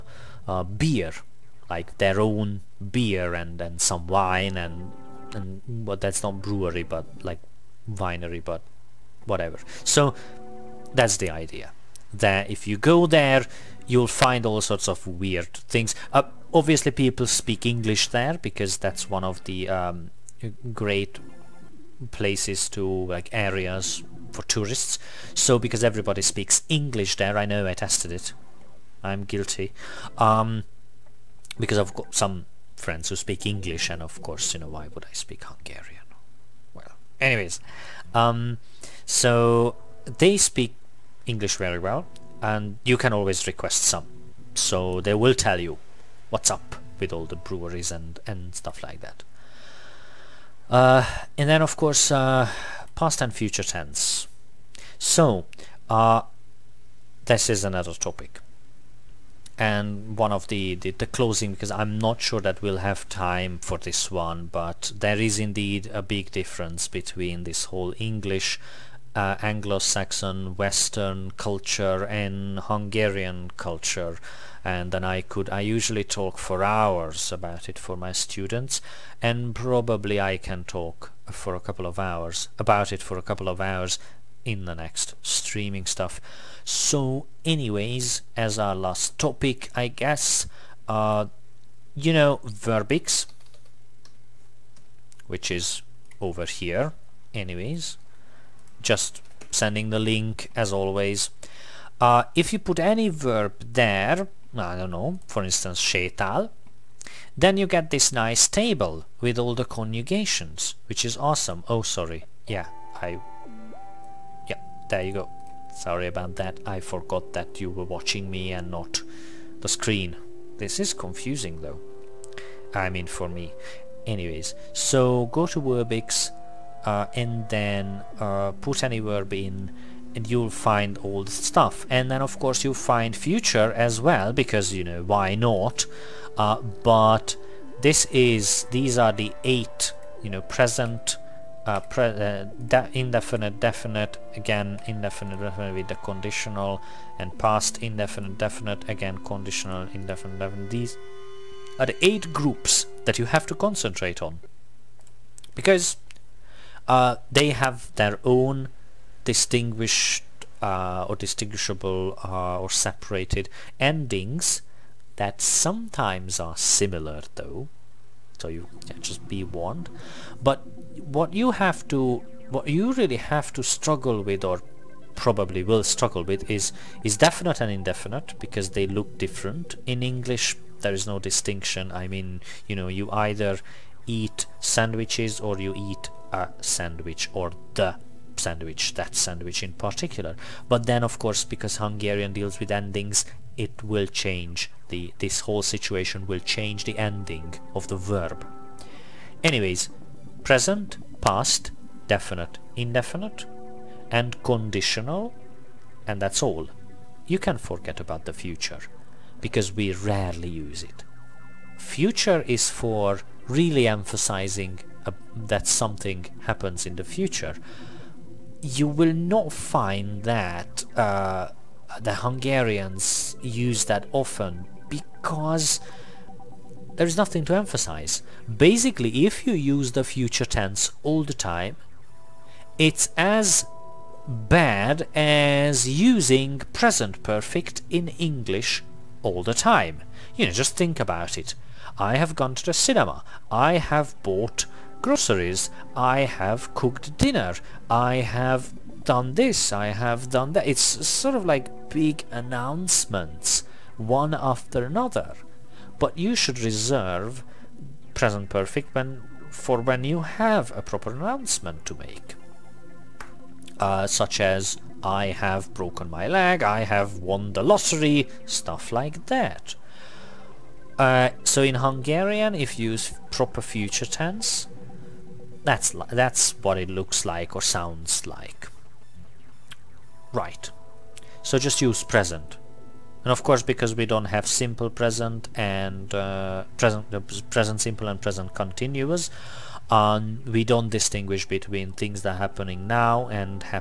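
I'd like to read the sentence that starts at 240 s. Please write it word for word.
You know, just think about it.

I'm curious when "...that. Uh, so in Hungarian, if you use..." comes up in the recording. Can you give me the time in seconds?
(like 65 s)
269 s.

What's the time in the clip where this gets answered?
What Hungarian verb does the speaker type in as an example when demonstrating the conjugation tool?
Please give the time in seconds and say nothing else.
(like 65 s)
105 s.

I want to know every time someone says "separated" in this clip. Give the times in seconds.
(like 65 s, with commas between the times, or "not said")
162 s.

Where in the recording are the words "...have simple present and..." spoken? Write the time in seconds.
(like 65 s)
284 s.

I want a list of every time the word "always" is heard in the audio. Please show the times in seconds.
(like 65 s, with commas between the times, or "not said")
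43 s, 100 s.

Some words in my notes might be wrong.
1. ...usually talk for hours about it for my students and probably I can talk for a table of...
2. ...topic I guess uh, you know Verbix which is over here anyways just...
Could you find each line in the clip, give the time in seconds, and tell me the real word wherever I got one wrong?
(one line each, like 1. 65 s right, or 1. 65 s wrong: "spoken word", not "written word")
1. 75 s wrong: "couple", not "table"
2. 89 s right.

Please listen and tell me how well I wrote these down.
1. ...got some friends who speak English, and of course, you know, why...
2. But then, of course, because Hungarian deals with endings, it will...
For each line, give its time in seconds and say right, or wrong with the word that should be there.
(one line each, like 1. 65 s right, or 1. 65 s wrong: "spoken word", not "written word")
1. 31 s right
2. 190 s right.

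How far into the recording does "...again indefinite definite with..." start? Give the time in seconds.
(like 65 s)
144 s.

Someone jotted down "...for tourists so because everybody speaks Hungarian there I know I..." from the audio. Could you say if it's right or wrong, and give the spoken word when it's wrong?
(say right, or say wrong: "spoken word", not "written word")
wrong: "English", not "Hungarian".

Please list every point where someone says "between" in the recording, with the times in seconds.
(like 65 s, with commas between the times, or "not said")
66 s, 291 s.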